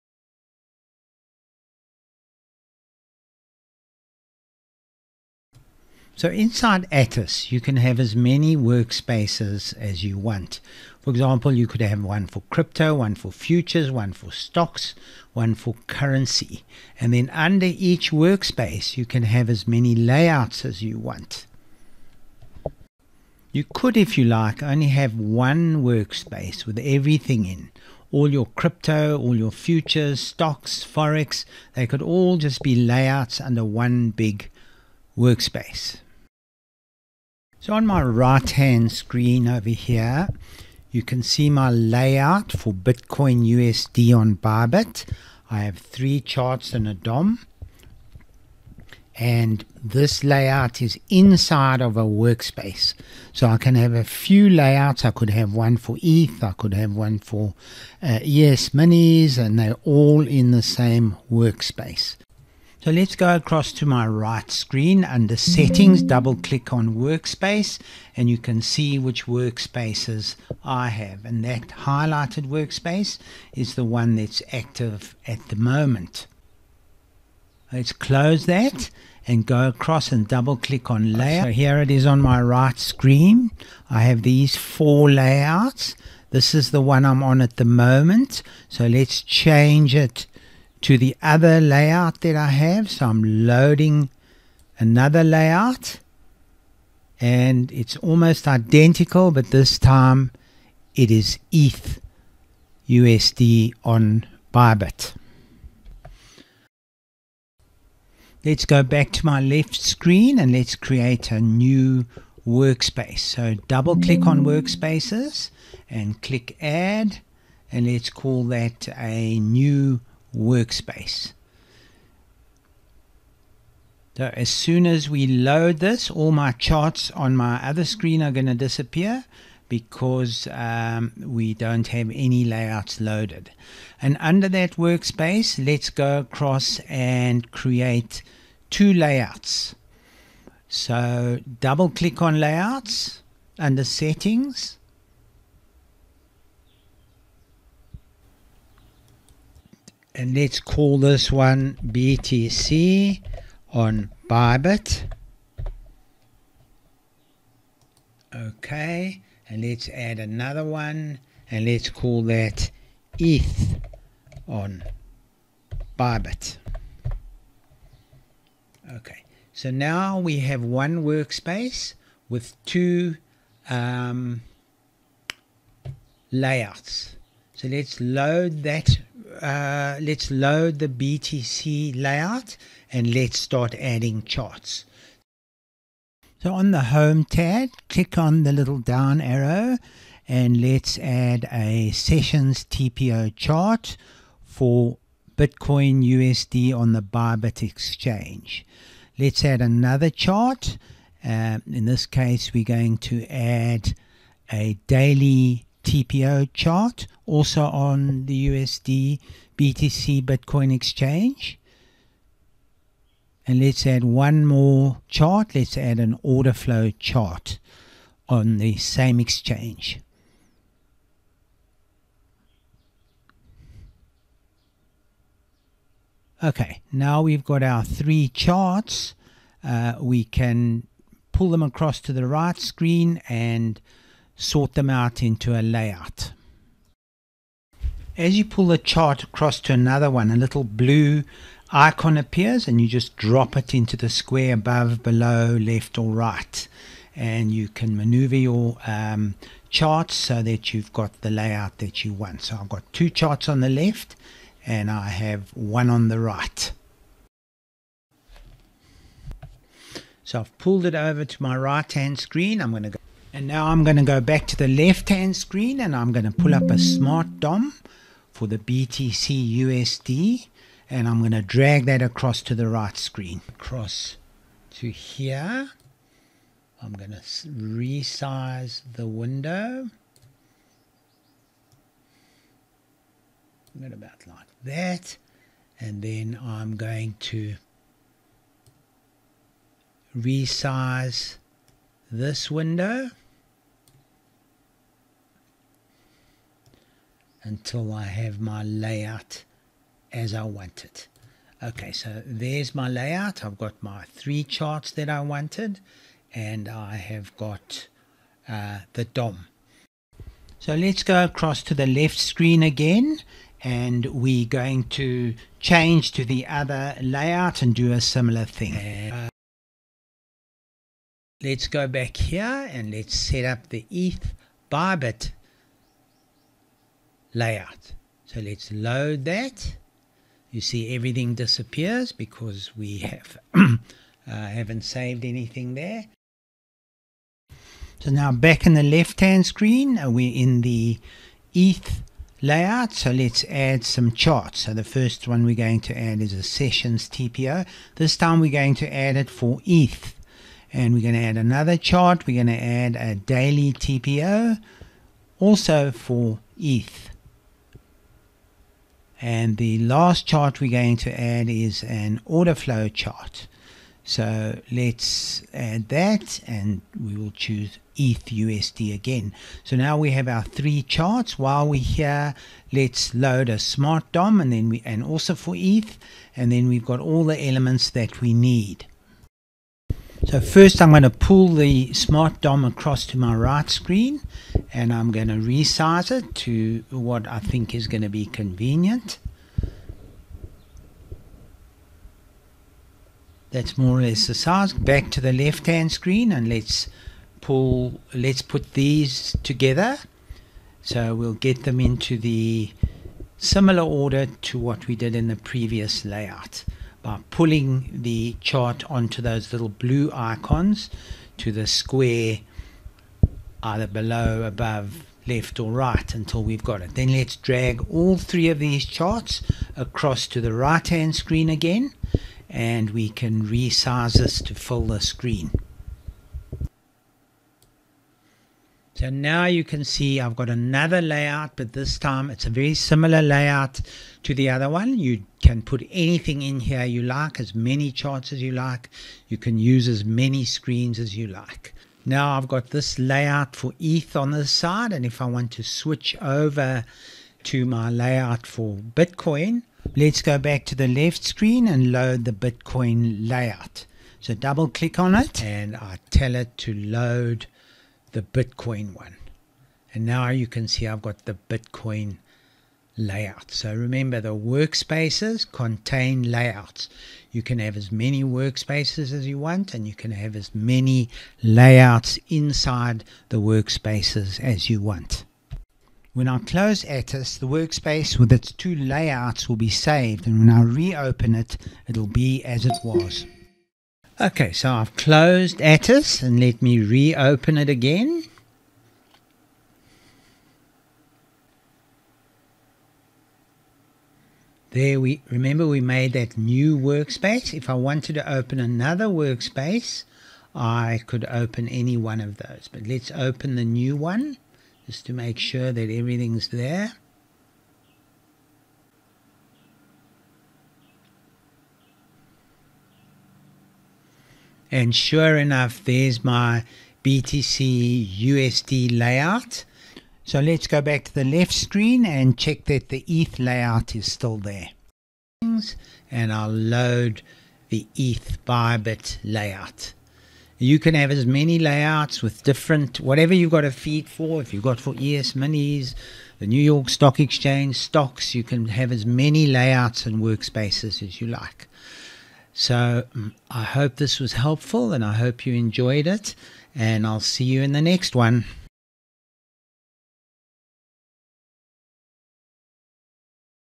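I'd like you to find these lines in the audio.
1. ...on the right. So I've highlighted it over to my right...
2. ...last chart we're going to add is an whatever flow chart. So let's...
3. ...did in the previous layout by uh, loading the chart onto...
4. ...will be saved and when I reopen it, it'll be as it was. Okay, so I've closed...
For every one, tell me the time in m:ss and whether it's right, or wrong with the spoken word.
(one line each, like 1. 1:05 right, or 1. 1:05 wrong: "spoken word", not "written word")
1. 4:15 wrong: "pulled", not "highlighted"
2. 5:59 wrong: "order", not "whatever"
3. 6:44 wrong: "pulling", not "loading"
4. 7:59 right.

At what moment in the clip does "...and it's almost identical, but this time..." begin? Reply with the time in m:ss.
1:37.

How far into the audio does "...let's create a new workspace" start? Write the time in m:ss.
1:50.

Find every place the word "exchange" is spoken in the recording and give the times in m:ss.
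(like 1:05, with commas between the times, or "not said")
3:17, 3:30, 3:39, 8:57.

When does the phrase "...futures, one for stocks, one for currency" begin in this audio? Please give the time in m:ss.
0:13.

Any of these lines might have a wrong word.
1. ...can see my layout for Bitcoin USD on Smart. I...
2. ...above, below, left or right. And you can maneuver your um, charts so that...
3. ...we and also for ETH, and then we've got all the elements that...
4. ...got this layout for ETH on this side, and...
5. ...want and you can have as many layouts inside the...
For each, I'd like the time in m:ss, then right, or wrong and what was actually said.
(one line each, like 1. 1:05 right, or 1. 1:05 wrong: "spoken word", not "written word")
1. 0:41 wrong: "Bybit", not "Smart"
2. 4:04 right
3. 6:14 right
4. 7:22 right
5. 7:49 right.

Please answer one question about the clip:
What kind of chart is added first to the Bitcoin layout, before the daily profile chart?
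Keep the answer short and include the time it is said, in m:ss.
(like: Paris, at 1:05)
sessions TPO chart, at 3:11.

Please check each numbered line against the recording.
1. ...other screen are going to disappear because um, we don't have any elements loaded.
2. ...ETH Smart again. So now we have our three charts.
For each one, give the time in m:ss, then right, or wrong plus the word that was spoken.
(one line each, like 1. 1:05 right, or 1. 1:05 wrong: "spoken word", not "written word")
1. 2:07 wrong: "layouts", not "elements"
2. 6:07 wrong: "USD", not "Smart".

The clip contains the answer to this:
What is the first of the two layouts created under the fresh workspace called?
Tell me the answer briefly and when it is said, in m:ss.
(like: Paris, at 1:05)
BTC on Bybit, at 2:31.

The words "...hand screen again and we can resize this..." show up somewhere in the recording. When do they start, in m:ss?
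7:00.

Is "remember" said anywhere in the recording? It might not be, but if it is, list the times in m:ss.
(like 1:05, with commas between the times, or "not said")
7:43, 8:15.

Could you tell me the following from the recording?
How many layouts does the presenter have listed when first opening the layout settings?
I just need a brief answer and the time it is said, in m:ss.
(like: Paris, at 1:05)
4, at 1:24.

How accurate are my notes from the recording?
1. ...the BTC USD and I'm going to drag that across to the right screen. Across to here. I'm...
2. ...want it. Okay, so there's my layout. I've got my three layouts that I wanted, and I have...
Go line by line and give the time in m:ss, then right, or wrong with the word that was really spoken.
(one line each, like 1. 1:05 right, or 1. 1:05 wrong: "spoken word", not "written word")
1. 4:28 right
2. 5:00 wrong: "charts", not "layouts".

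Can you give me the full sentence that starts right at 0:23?
You could, if you like, only have one workspace with everything in.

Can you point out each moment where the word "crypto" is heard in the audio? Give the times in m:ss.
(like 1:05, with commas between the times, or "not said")
0:12, 0:28.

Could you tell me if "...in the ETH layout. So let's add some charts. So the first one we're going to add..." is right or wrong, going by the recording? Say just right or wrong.
right.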